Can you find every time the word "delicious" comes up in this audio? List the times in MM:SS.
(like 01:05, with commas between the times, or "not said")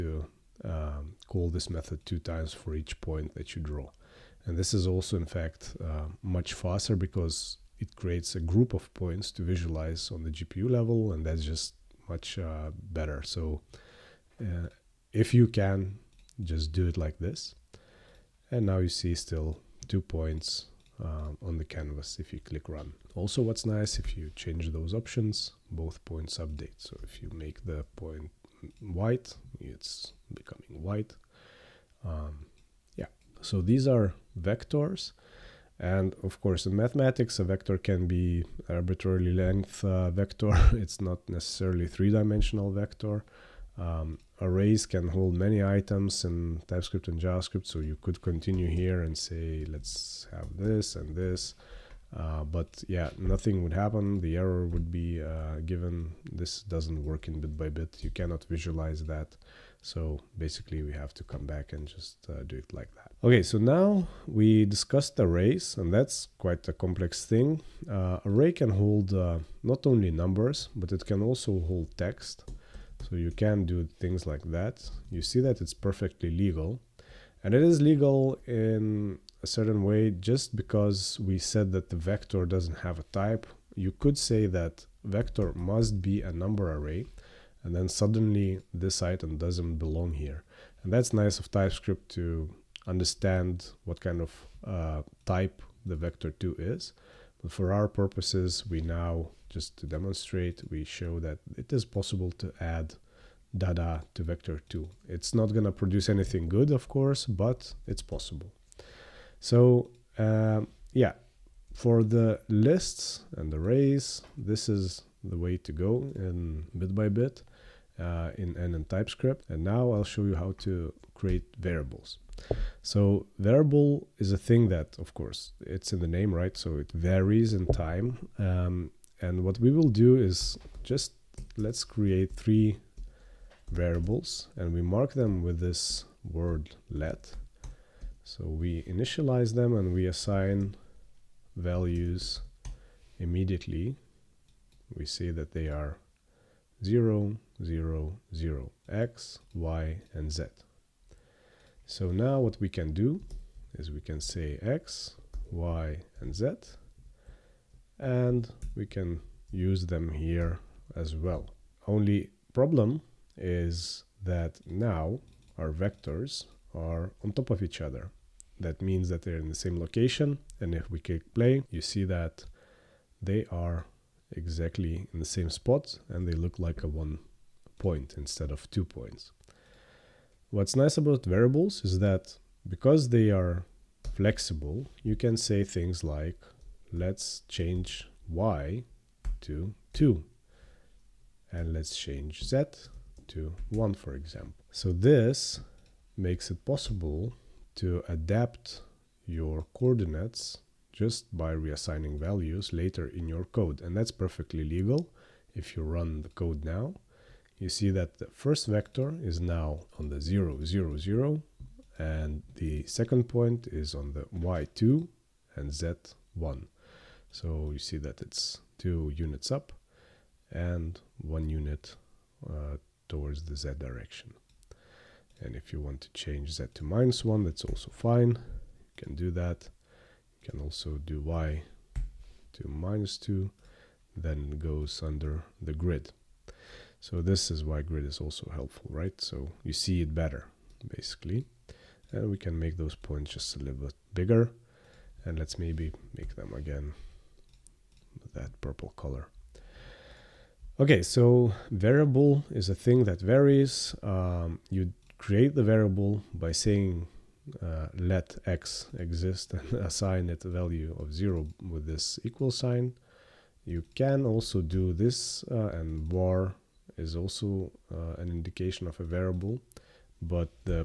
not said.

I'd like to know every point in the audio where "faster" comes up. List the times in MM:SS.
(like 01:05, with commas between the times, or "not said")
00:06.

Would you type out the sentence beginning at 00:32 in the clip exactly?
Um, yeah, so these are vectors.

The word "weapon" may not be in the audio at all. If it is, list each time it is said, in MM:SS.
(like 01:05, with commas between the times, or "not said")
not said.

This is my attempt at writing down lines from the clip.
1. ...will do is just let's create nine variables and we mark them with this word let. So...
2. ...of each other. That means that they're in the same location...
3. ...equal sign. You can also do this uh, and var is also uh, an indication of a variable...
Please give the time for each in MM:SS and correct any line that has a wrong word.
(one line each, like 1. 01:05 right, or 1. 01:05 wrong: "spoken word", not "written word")
1. 02:09 wrong: "three", not "nine"
2. 02:47 right
3. 04:22 right.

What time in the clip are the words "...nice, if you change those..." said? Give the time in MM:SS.
00:23.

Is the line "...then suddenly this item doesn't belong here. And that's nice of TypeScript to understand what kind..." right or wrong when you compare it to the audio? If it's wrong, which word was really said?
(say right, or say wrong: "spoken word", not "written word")
right.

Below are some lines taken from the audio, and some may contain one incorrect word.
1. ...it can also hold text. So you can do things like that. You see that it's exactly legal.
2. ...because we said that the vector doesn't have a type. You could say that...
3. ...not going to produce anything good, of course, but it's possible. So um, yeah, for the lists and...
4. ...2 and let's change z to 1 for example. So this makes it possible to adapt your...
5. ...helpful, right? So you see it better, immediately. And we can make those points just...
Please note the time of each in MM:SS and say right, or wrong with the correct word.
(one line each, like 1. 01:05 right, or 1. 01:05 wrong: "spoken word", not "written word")
1. 01:10 wrong: "perfectly", not "exactly"
2. 01:20 right
3. 01:45 right
4. 03:09 right
5. 03:58 wrong: "basically", not "immediately".